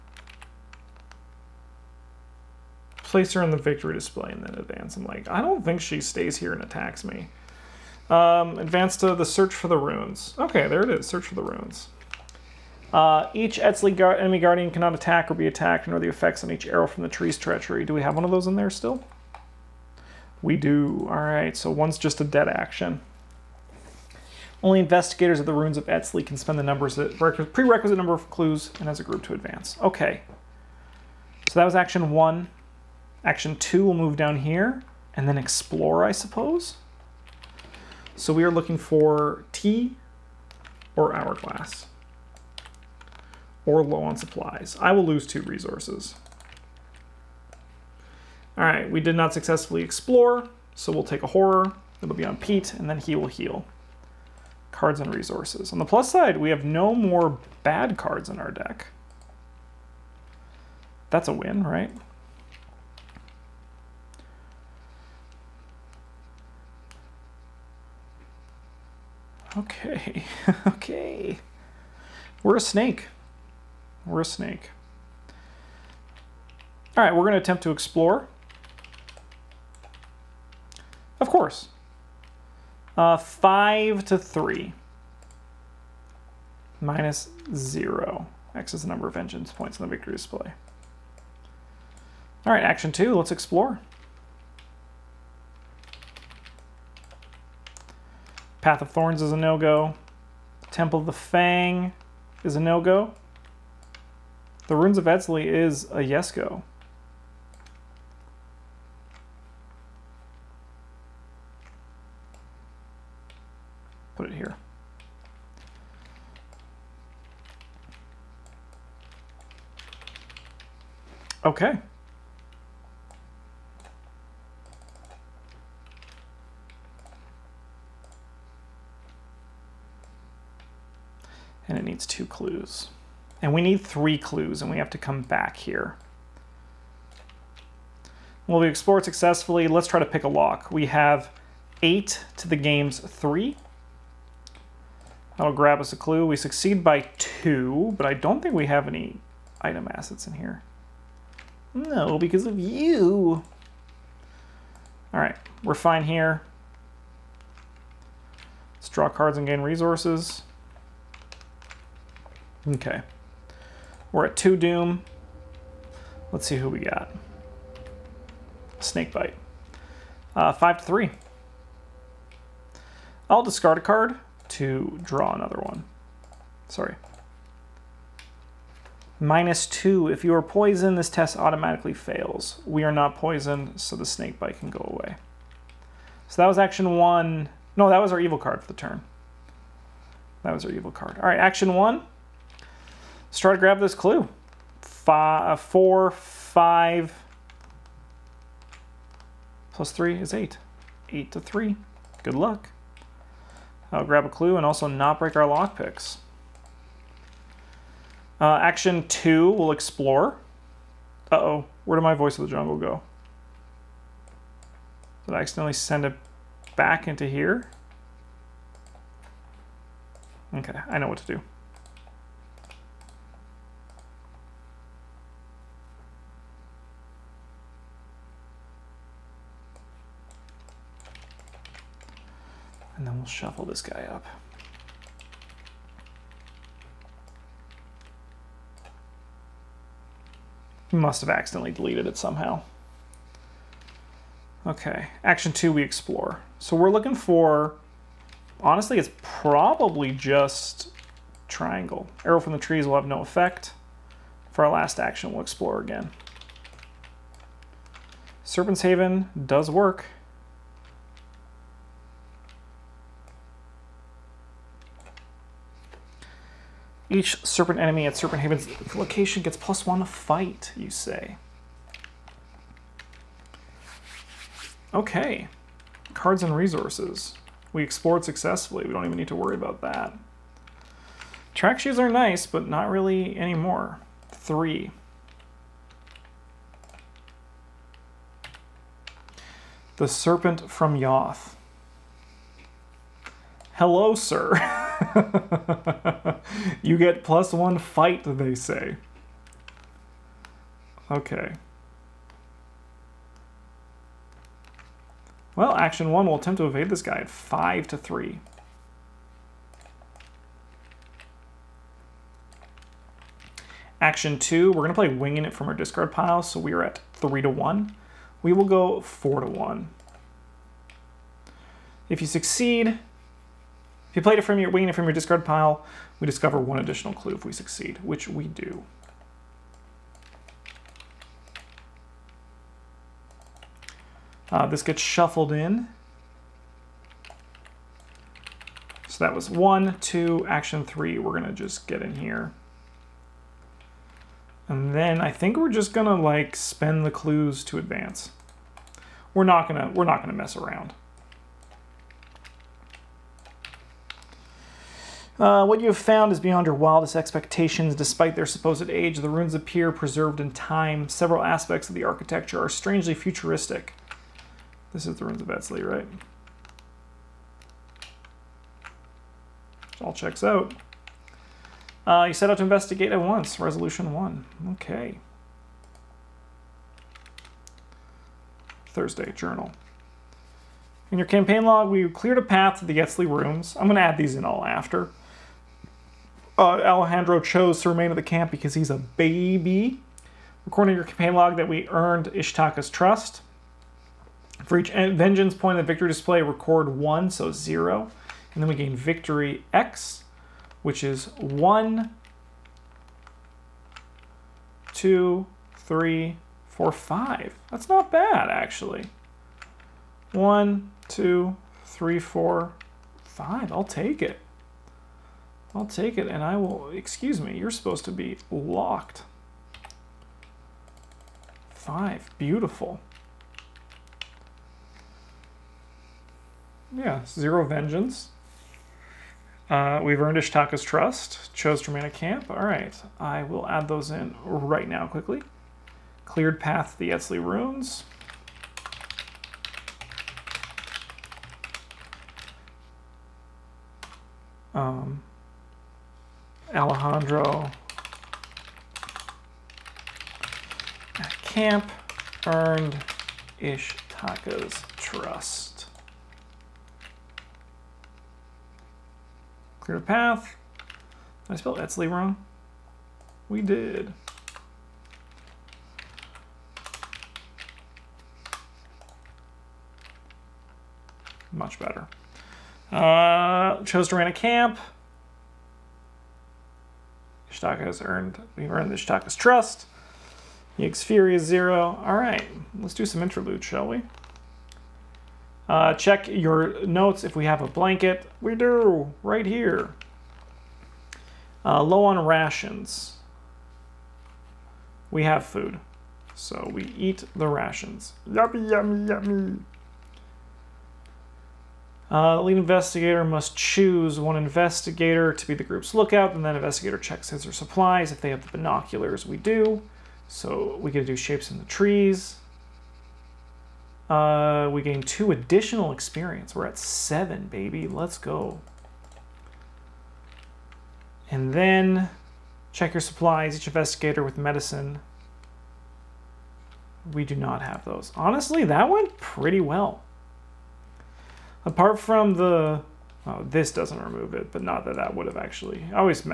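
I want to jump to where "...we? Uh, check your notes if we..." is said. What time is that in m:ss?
8:03.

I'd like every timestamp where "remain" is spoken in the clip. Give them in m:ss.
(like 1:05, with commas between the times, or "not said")
6:27, 7:11.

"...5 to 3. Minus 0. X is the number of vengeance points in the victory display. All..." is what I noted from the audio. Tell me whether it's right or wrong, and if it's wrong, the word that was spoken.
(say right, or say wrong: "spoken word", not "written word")
right.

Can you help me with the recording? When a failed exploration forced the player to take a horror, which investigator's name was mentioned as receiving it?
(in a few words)
Pete.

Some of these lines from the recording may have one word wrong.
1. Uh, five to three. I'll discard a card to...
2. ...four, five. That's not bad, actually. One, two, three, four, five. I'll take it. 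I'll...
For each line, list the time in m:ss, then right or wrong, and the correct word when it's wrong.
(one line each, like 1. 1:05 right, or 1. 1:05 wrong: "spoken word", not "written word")
1. 2:50 right
2. 6:46 right.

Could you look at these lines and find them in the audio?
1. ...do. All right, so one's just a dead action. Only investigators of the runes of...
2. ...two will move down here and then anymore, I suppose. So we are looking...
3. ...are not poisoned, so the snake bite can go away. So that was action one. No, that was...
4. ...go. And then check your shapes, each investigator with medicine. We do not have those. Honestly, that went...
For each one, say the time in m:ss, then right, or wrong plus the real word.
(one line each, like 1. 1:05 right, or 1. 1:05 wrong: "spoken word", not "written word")
1. 0:20 right
2. 0:33 wrong: "explore", not "anymore"
3. 3:02 right
4. 8:38 wrong: "supplies", not "shapes".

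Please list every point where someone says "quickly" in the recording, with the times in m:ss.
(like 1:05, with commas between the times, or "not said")
7:15.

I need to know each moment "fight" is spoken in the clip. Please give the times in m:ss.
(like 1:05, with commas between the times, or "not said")
4:30, 4:57.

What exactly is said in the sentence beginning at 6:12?
Uh, you set out to investigate at once.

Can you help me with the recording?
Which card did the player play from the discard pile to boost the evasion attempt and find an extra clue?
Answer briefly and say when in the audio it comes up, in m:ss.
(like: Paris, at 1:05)
Winging it, at 5:15.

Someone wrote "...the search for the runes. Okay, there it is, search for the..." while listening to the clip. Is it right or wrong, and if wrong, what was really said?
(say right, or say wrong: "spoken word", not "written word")
right.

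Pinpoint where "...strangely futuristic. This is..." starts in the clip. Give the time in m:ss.
6:02.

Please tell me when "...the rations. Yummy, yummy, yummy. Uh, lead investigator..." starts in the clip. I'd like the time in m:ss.
8:17.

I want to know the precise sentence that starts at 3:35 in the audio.
Did I accidentally send it back into here?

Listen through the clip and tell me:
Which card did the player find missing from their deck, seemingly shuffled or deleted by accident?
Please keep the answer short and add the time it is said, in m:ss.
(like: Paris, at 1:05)
Voice of the Jungle, at 3:32.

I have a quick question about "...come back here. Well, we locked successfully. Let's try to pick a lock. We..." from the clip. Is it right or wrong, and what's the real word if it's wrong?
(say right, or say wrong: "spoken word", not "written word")
wrong: "explored", not "locked".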